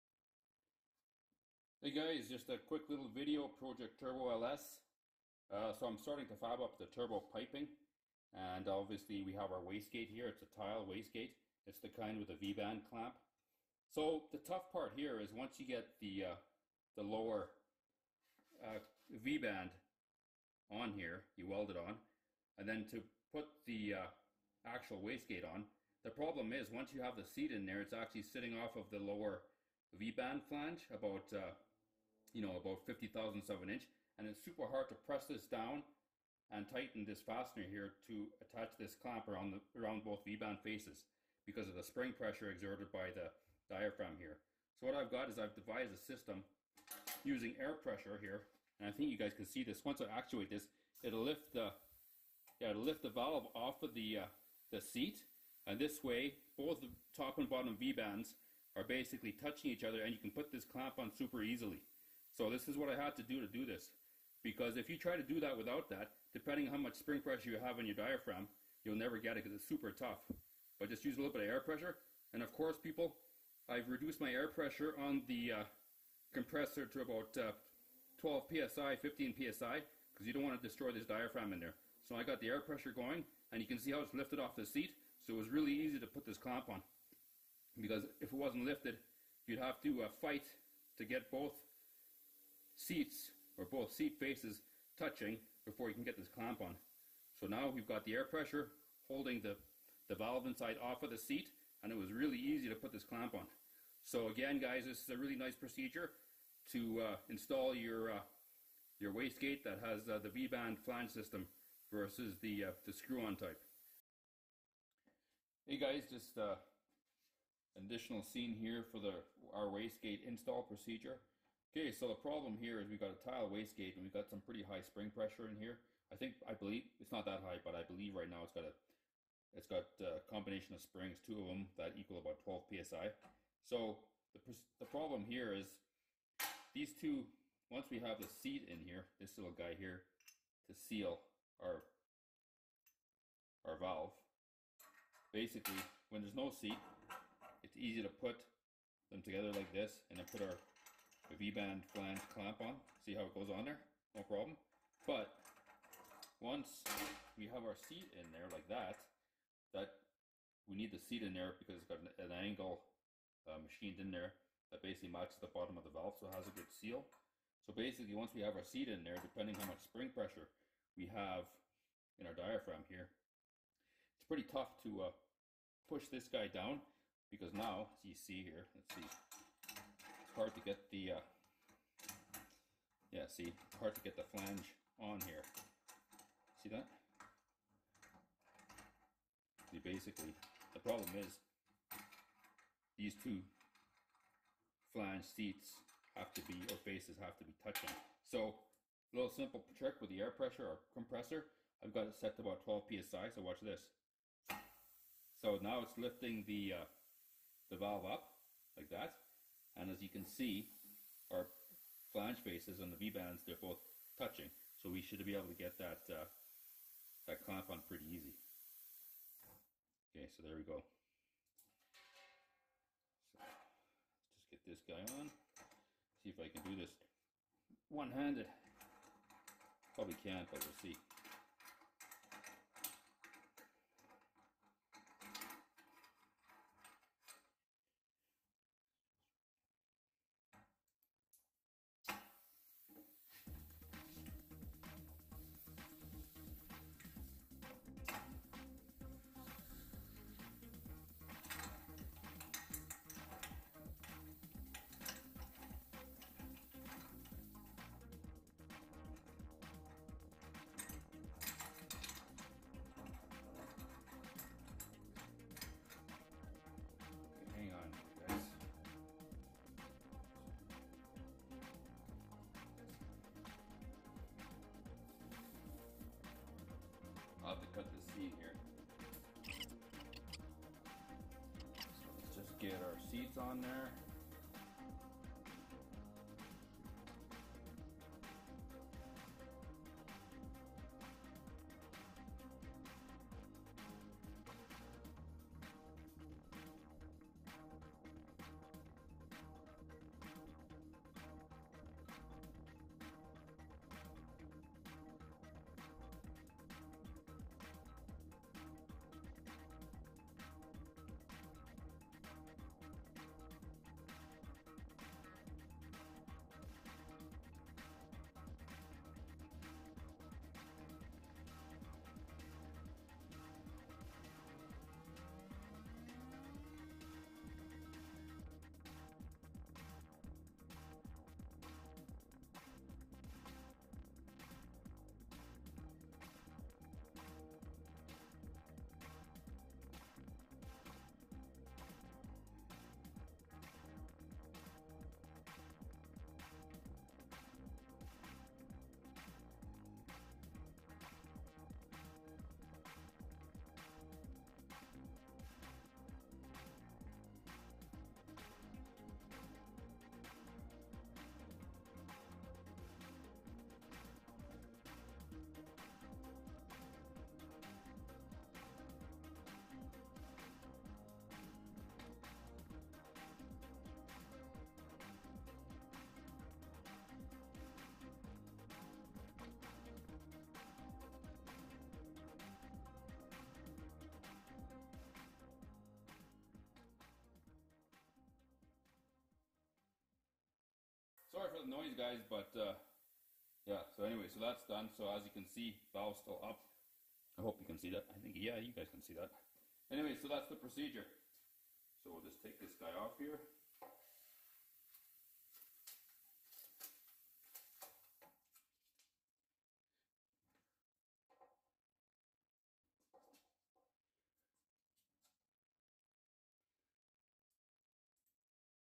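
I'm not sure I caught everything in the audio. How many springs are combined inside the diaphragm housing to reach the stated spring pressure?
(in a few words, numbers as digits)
2.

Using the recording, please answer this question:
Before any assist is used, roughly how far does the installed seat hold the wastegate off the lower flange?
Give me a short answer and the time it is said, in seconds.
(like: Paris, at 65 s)
50 thousandths of an inch, at 32 s.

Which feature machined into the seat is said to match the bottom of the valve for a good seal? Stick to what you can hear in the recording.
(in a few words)
An angle.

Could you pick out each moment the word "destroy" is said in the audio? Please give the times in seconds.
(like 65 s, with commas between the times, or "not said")
80 s.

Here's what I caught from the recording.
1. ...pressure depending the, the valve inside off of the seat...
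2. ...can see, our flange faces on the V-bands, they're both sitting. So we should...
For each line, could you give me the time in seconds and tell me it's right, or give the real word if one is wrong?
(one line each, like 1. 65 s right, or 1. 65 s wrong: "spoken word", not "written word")
1. 98 s wrong: "holding", not "depending"
2. 210 s wrong: "touching", not "sitting".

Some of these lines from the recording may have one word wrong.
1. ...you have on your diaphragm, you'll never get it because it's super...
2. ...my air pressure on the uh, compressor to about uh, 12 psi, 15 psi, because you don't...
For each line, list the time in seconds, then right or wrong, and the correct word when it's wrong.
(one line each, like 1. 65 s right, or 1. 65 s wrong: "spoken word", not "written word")
1. 67 s right
2. 74 s right.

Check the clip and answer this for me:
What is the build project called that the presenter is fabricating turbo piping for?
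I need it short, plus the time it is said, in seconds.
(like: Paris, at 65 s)
Project Turbo LS, at 3 s.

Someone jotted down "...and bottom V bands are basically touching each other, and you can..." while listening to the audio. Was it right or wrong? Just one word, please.
right.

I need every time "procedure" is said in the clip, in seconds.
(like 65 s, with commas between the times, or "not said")
105 s, 120 s, 400 s.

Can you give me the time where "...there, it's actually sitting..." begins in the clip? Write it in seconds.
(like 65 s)
27 s.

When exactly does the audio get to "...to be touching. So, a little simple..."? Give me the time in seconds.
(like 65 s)
197 s.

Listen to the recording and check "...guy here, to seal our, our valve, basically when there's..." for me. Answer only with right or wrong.
right.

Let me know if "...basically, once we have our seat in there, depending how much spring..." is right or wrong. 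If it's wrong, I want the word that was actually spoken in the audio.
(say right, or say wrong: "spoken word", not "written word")
right.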